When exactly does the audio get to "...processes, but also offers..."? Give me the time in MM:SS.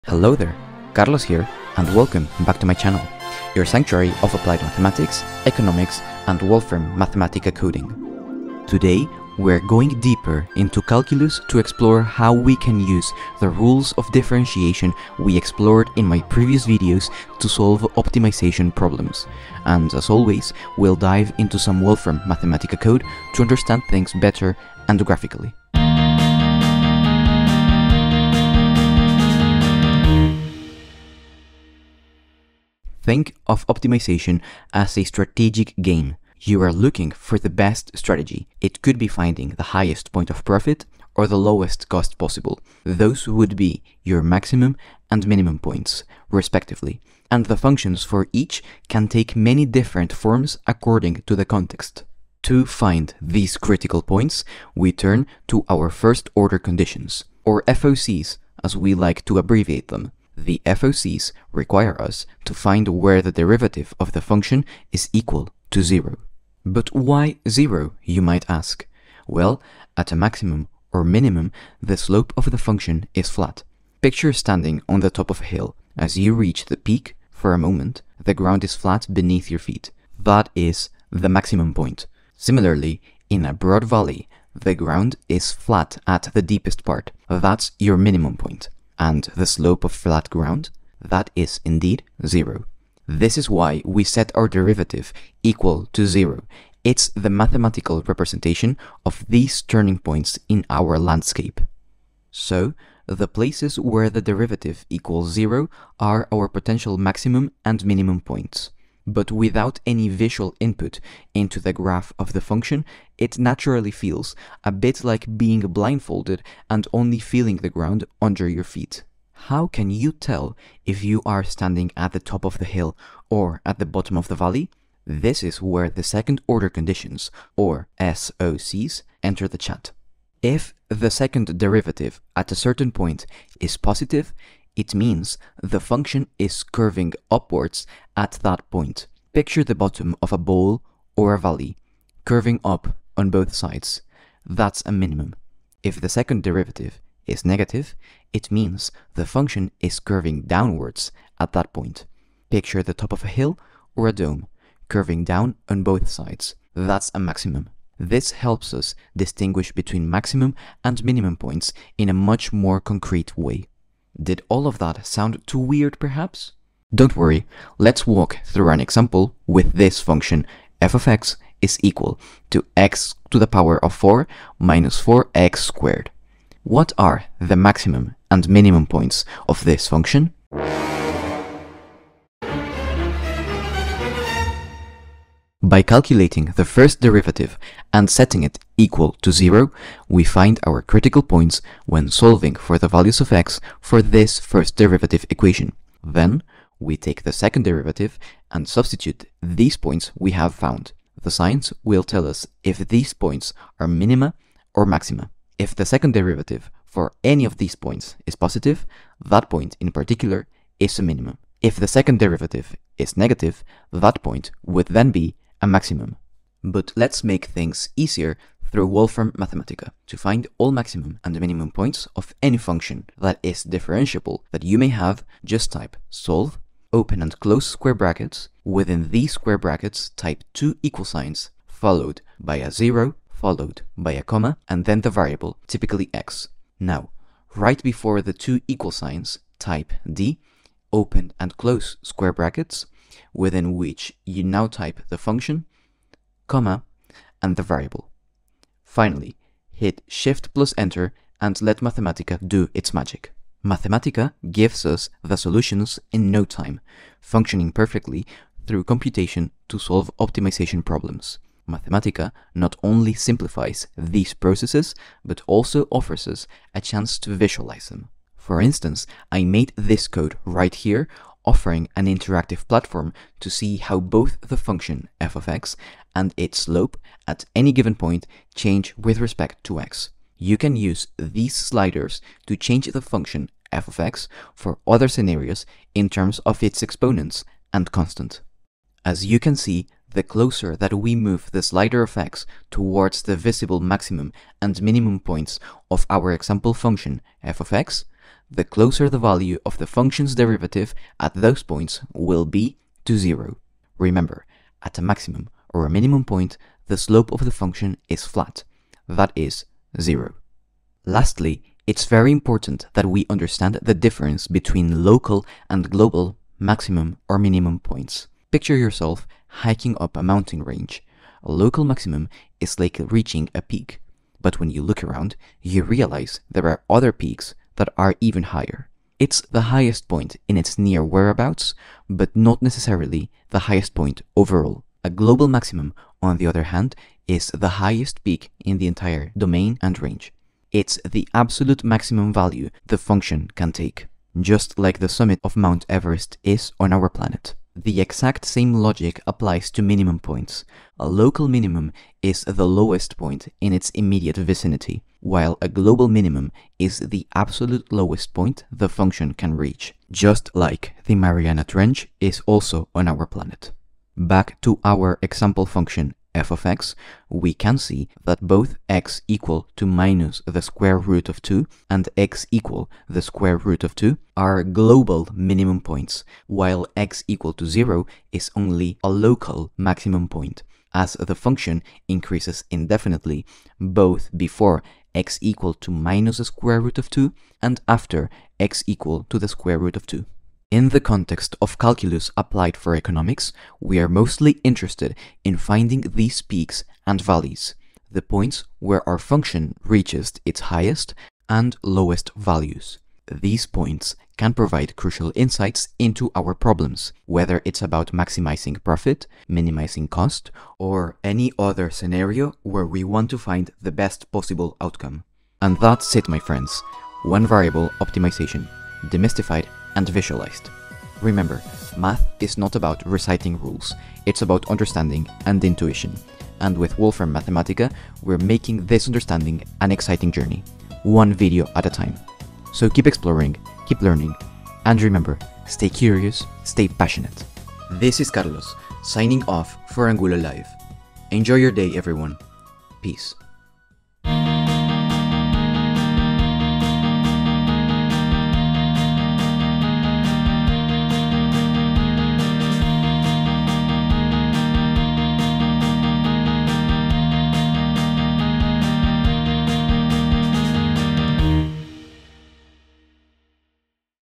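04:24.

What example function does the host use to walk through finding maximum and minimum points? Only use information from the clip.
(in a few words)
x^4 - 4x^2.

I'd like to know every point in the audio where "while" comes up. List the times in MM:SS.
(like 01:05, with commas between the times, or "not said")
05:55, 06:16.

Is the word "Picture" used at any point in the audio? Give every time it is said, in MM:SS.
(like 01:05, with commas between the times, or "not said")
01:14, 02:19, 02:32, 05:18.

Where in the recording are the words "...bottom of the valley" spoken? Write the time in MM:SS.
02:03.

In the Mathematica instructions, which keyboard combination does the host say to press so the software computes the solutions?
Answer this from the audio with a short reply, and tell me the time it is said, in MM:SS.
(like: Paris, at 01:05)
Shift plus Enter, at 04:10.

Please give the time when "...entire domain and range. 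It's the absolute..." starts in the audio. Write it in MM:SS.
05:38.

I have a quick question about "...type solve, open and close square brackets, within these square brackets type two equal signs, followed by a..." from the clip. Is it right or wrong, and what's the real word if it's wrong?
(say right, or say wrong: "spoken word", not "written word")
right.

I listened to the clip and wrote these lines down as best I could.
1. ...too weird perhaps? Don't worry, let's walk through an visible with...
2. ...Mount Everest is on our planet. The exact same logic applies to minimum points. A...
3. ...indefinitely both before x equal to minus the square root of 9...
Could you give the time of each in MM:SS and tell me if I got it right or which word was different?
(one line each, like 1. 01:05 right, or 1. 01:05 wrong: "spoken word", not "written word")
1. 02:45 wrong: "example", not "visible"
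2. 05:45 right
3. 06:22 wrong: "2", not "9".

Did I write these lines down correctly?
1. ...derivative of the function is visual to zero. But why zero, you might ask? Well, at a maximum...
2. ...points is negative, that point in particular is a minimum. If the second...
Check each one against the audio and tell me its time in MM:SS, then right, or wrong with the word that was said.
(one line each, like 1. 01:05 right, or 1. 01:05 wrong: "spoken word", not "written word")
1. 01:03 wrong: "equal", not "visual"
2. 03:27 wrong: "positive", not "negative".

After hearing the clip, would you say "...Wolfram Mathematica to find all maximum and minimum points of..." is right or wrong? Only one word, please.
right.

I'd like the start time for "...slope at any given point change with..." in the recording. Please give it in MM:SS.
04:36.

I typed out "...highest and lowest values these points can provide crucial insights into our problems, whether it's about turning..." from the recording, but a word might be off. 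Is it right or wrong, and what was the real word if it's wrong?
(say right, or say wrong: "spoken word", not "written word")
wrong: "maximizing", not "turning".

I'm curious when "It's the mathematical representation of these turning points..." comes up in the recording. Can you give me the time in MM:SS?
01:36.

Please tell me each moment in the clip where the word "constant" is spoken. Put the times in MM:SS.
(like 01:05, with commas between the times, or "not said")
04:47.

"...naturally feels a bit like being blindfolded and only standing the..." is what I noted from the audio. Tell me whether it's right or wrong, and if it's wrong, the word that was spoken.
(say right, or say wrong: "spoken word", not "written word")
wrong: "feeling", not "standing".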